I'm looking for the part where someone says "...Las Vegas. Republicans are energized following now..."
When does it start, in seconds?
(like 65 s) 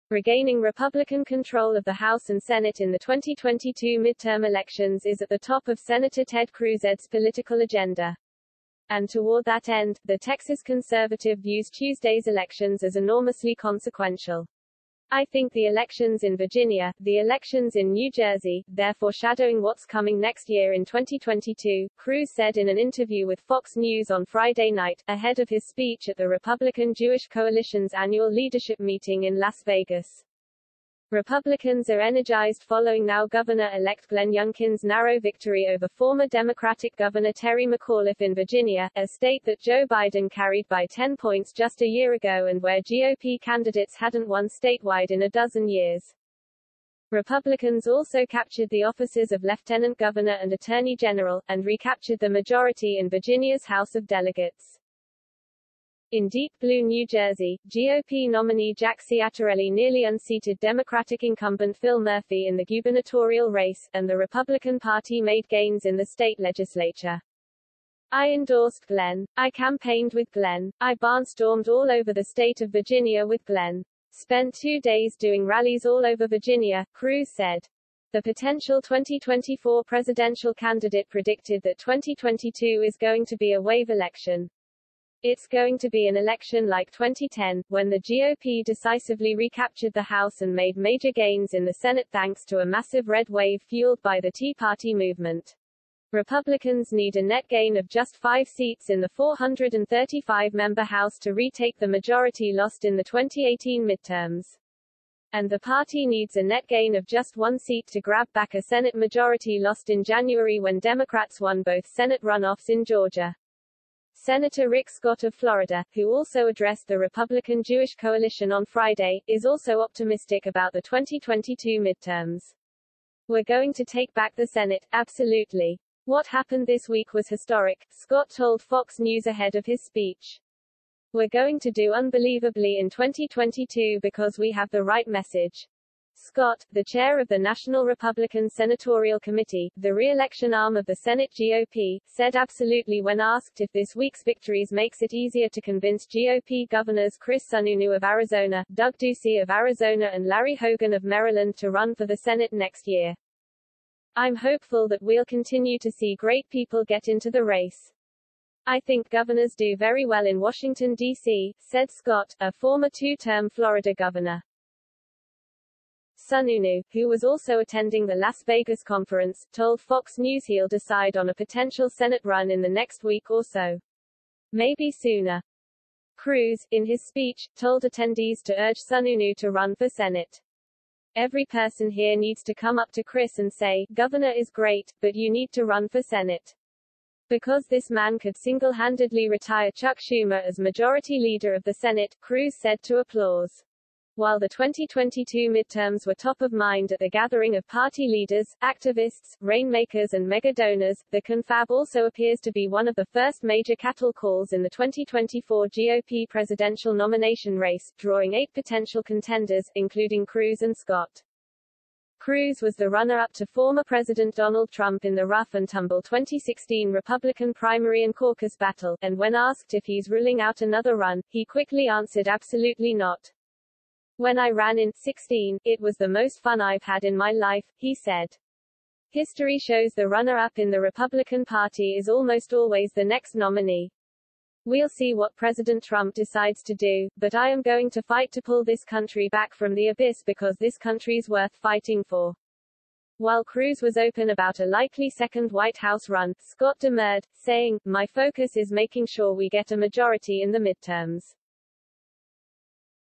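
29 s.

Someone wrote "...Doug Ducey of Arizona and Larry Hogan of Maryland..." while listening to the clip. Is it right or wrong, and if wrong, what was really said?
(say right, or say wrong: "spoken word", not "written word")
right.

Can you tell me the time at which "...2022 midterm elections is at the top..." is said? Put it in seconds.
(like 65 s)
2 s.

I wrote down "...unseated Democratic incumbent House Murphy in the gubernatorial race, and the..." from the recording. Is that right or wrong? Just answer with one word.
wrong.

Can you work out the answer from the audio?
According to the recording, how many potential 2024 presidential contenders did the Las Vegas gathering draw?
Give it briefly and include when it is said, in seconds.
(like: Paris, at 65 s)
8, at 208 s.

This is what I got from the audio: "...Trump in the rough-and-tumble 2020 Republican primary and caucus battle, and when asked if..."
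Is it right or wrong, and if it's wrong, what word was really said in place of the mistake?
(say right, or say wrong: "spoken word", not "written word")
wrong: "2016", not "2020".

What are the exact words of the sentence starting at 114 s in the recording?
Senator Rick Scott of Florida, who also addressed the Republican Jewish coalition on Friday, is also optimistic about the 2022 midterms.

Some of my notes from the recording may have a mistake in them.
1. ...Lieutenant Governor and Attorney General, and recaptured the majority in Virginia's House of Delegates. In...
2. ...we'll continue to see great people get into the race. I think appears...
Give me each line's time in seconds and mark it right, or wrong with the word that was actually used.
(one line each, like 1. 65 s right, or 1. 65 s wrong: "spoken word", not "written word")
1. 49 s right
2. 155 s wrong: "governors", not "appears".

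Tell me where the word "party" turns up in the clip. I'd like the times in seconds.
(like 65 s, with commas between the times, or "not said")
64 s, 94 s, 105 s, 197 s, 231 s.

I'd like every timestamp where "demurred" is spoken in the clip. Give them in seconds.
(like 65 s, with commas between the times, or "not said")
246 s.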